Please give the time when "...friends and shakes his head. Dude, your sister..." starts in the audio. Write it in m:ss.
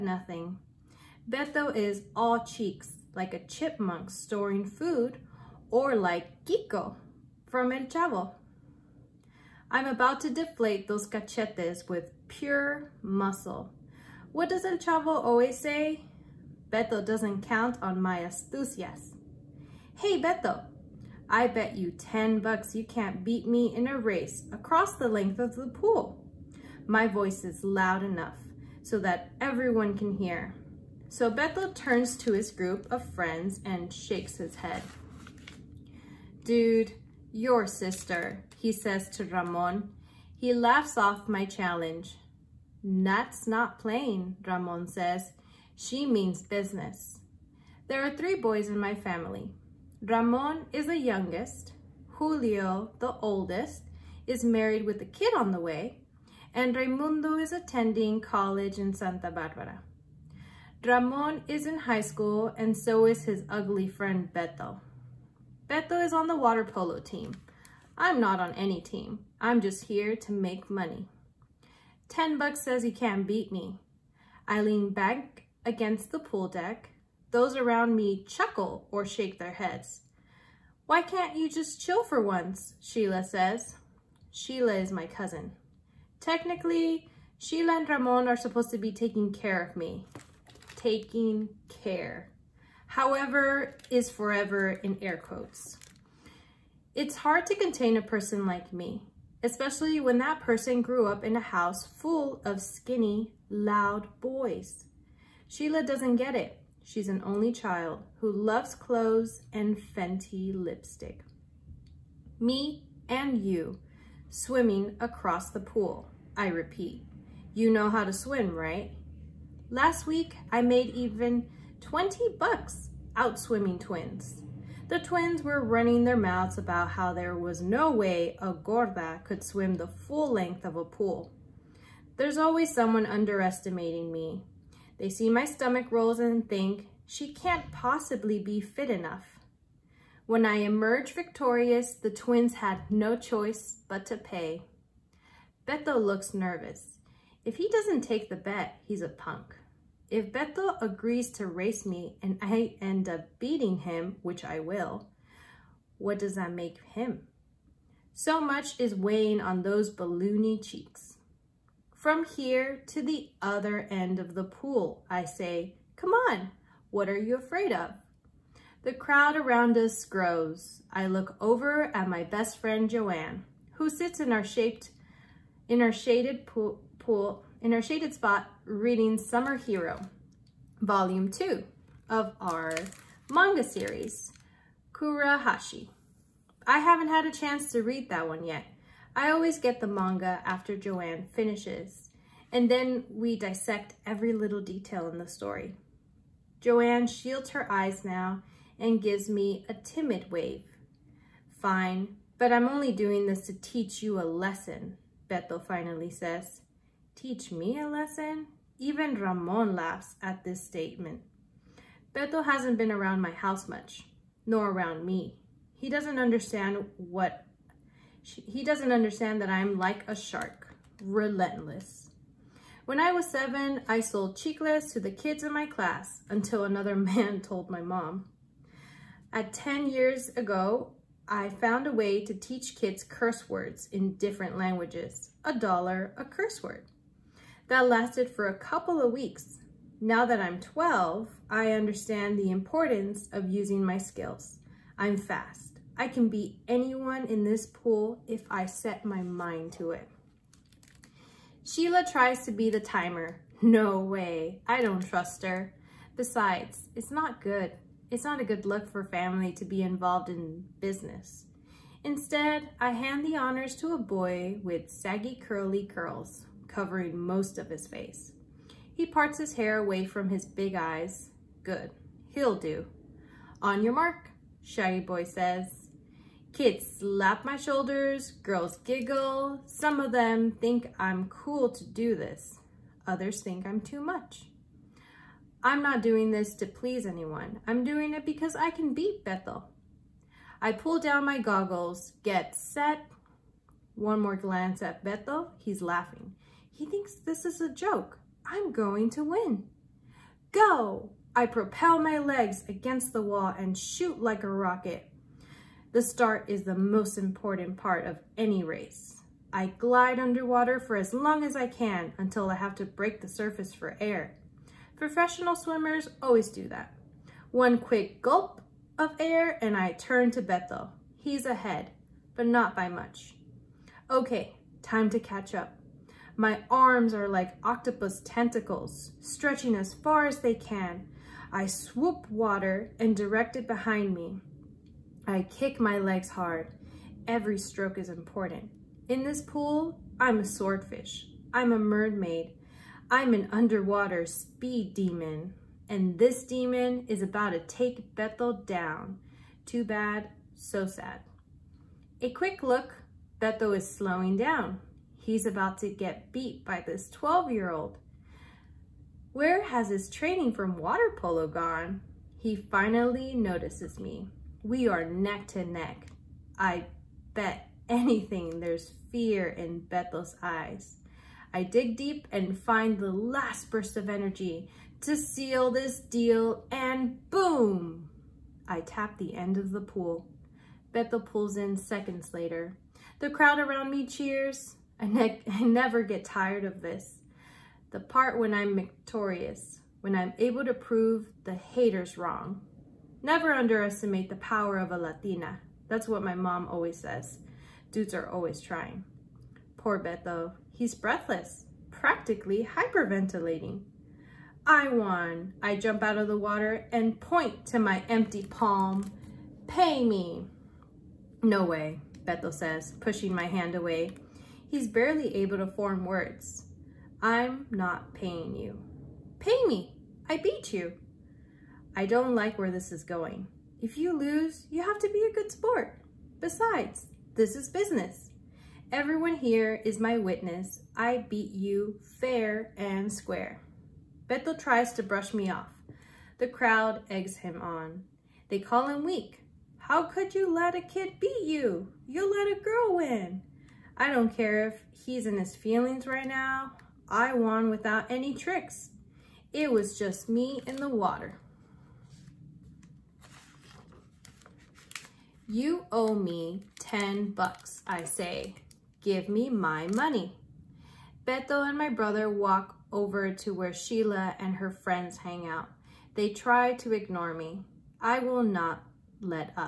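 0:33.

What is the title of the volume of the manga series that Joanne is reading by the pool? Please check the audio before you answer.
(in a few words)
Summer Hero.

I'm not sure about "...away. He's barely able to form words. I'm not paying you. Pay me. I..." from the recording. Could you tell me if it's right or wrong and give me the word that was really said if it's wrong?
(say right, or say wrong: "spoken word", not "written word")
right.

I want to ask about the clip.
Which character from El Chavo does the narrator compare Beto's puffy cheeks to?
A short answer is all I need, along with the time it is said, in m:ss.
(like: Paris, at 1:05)
Kiko, at 0:06.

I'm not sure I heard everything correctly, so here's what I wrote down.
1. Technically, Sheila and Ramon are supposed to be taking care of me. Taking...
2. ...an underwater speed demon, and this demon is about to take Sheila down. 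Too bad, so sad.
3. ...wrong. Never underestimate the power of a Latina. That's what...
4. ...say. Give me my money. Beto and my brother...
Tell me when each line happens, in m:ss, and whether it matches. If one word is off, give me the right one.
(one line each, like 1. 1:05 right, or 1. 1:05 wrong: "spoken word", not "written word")
1. 1:26 right
2. 5:43 wrong: "Bethel", not "Sheila"
3. 6:32 right
4. 7:38 right.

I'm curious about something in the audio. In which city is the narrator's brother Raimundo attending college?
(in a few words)
Santa Barbara.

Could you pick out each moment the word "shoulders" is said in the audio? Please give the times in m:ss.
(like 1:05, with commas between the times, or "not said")
4:37.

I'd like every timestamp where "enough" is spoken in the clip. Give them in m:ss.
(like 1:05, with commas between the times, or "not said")
0:28, 2:18.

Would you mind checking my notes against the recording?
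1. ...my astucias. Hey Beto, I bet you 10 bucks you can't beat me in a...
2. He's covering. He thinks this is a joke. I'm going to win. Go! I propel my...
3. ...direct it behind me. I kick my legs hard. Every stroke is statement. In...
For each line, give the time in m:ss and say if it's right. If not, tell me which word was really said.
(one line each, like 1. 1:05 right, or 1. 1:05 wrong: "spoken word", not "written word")
1. 0:18 right
2. 4:55 wrong: "laughing", not "covering"
3. 5:33 wrong: "important", not "statement".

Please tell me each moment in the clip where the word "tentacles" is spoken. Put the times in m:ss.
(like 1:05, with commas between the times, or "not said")
5:28.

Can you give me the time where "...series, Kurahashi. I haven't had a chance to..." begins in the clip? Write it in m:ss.
3:03.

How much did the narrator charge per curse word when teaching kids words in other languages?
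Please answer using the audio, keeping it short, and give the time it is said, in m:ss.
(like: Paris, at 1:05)
$1, at 3:55.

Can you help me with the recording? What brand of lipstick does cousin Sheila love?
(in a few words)
Fenty.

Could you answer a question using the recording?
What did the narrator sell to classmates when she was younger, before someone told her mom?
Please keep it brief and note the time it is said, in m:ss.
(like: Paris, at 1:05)
chicles, at 3:44.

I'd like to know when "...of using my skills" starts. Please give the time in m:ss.
4:03.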